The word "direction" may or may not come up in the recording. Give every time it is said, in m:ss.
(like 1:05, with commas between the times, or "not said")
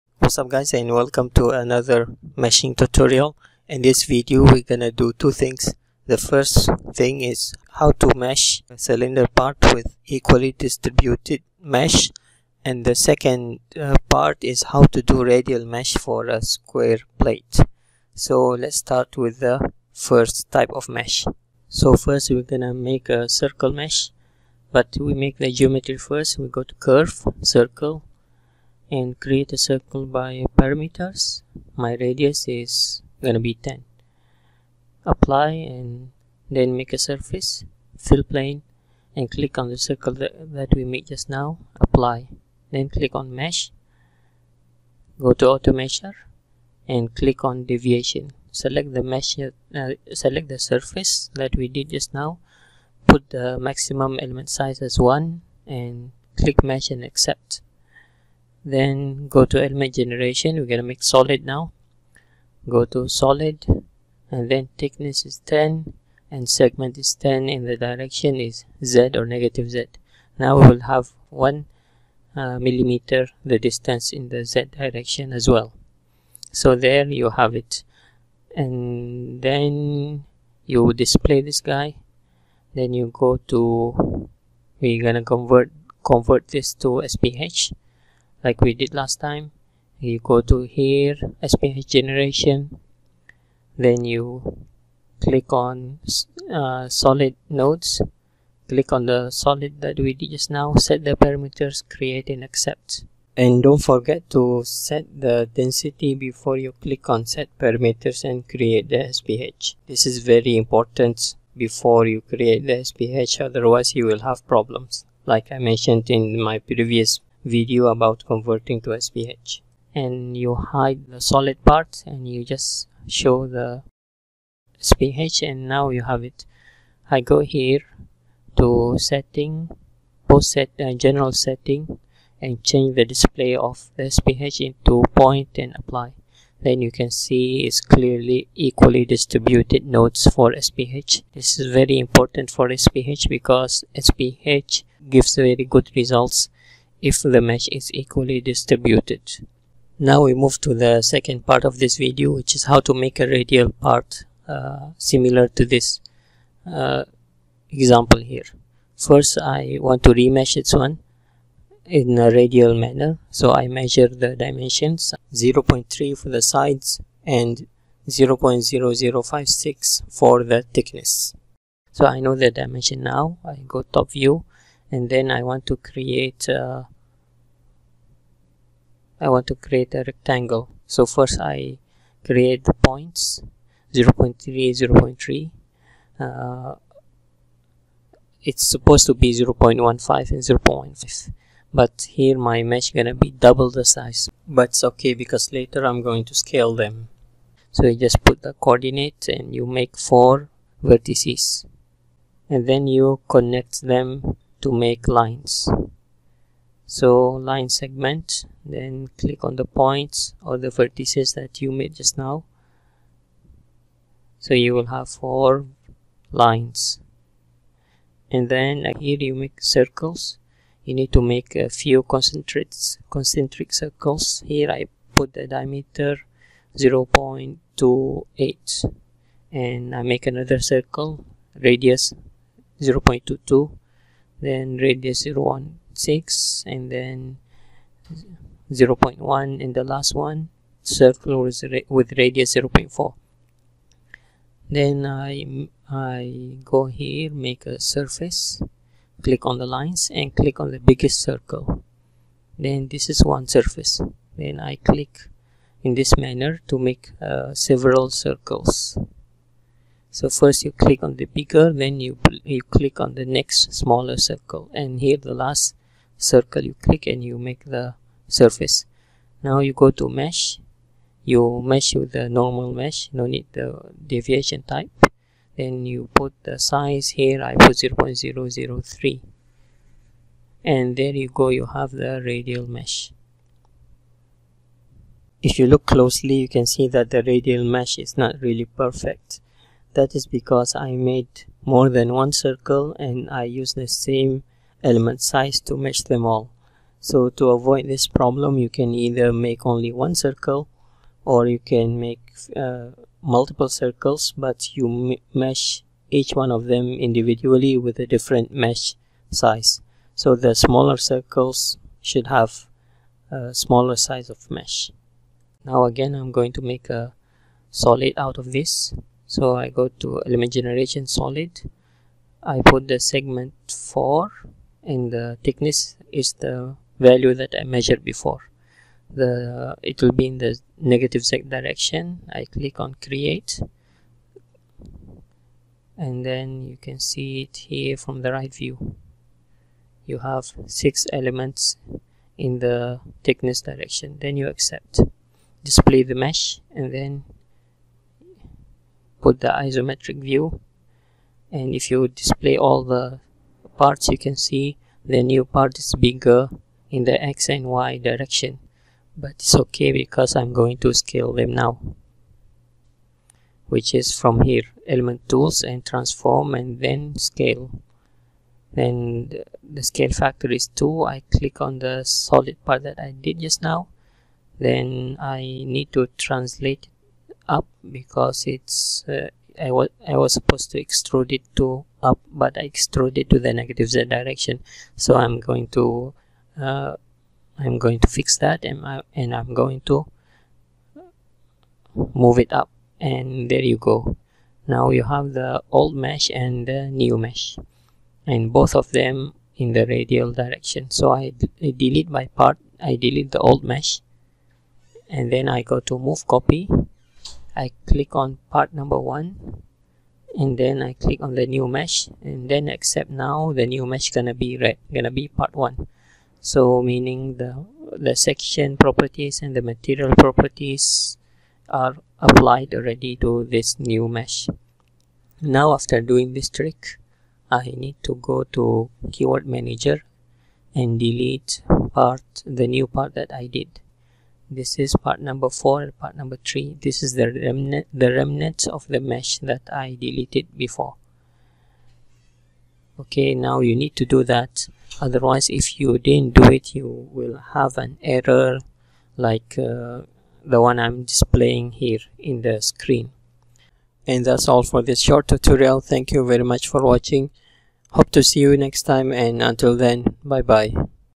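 1:07, 1:14, 5:31, 5:43, 5:57, 6:24, 6:40.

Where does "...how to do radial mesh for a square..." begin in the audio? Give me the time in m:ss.
0:14.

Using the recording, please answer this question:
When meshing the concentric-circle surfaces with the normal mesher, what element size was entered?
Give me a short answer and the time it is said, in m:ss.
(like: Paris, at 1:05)
0.003, at 4:37.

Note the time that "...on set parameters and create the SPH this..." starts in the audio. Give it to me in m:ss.
1:47.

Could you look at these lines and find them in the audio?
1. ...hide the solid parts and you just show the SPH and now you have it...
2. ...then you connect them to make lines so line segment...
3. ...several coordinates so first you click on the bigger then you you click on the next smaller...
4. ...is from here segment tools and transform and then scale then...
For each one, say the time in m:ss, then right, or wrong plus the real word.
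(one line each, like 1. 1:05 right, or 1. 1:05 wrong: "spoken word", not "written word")
1. 2:00 right
2. 3:22 right
3. 4:17 wrong: "circles", not "coordinates"
4. 6:03 wrong: "element", not "segment".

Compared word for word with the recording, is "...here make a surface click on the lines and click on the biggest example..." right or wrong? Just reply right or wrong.
wrong.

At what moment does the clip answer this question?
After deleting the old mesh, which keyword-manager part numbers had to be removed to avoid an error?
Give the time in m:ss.
7:15.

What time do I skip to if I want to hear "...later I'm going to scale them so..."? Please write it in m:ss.
3:15.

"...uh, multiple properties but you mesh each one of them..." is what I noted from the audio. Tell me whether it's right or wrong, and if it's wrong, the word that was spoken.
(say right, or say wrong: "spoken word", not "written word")
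wrong: "circles", not "properties".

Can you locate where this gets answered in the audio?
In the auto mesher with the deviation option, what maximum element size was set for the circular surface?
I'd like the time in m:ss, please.
0:53.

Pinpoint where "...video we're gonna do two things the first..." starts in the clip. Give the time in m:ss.
0:04.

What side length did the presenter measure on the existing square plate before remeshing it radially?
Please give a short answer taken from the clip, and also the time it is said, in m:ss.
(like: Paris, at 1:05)
0.3, at 2:45.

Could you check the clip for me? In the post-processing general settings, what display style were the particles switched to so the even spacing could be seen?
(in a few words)
point.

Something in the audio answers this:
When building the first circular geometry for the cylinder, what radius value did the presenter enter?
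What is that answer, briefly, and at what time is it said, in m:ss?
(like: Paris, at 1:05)
10, at 0:31.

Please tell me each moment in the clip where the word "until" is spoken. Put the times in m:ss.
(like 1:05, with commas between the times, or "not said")
7:39.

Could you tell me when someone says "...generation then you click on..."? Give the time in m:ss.
1:31.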